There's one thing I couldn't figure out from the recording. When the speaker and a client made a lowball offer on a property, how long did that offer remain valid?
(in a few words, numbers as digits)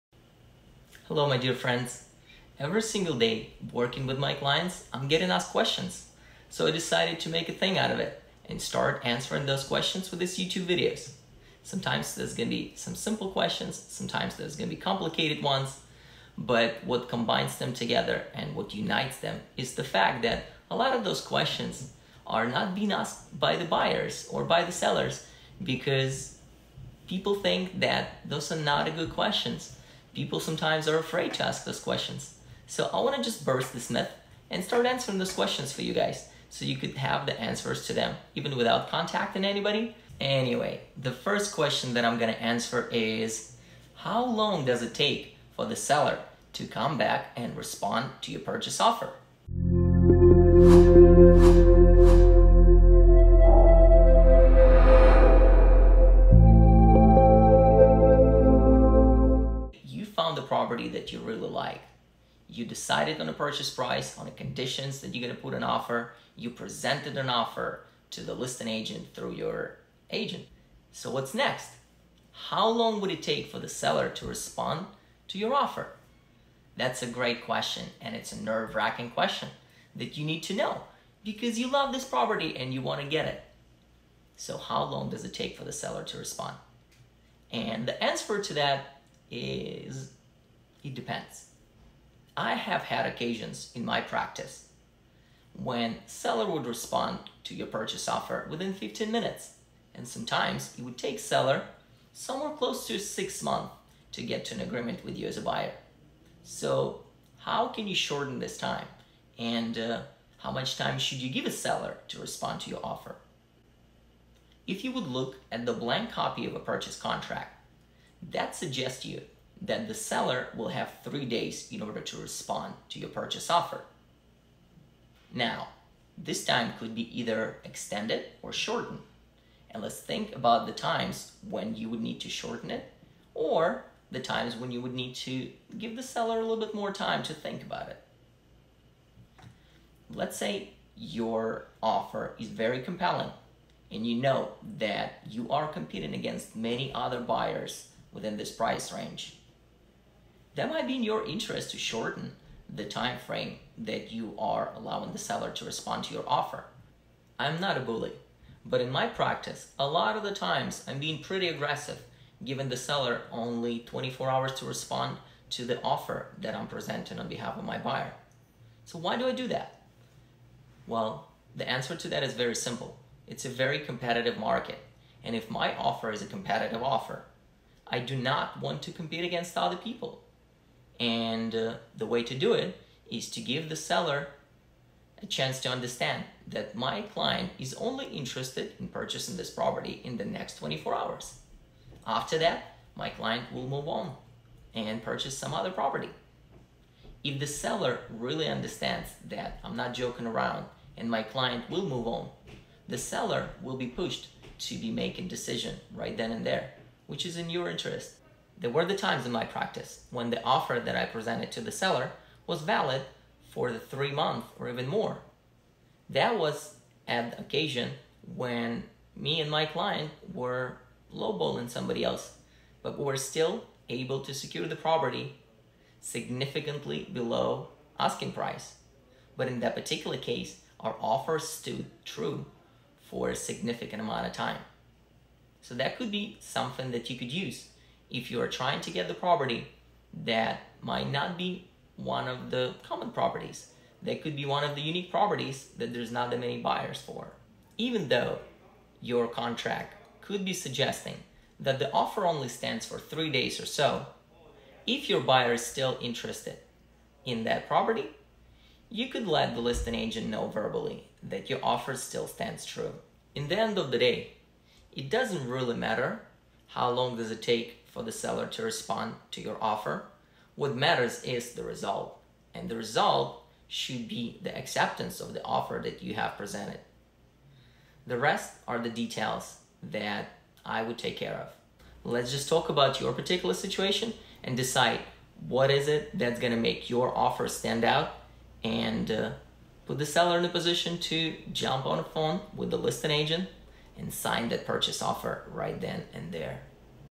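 3 months.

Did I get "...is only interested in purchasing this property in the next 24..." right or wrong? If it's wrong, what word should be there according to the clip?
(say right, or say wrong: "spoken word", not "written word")
right.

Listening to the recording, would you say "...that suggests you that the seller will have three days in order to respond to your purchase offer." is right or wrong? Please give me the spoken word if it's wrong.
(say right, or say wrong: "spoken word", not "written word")
right.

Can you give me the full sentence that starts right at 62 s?
You decided on a purchase price, on the conditions that you're gonna put an offer.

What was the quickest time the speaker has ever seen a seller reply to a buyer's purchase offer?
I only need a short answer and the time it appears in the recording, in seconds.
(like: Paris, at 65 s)
15 minutes, at 98 s.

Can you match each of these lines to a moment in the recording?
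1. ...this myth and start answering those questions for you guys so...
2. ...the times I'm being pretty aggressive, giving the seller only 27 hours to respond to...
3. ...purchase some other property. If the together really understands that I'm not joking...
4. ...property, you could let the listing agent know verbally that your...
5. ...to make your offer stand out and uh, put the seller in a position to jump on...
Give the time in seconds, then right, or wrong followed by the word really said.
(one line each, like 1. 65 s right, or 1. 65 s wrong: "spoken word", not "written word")
1. 33 s right
2. 160 s wrong: "24", not "27"
3. 195 s wrong: "seller", not "together"
4. 257 s right
5. 286 s right.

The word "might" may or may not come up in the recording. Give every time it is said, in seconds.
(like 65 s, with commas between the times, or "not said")
150 s, 240 s.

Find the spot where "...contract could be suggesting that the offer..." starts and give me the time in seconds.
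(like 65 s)
249 s.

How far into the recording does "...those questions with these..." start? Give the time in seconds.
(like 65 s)
9 s.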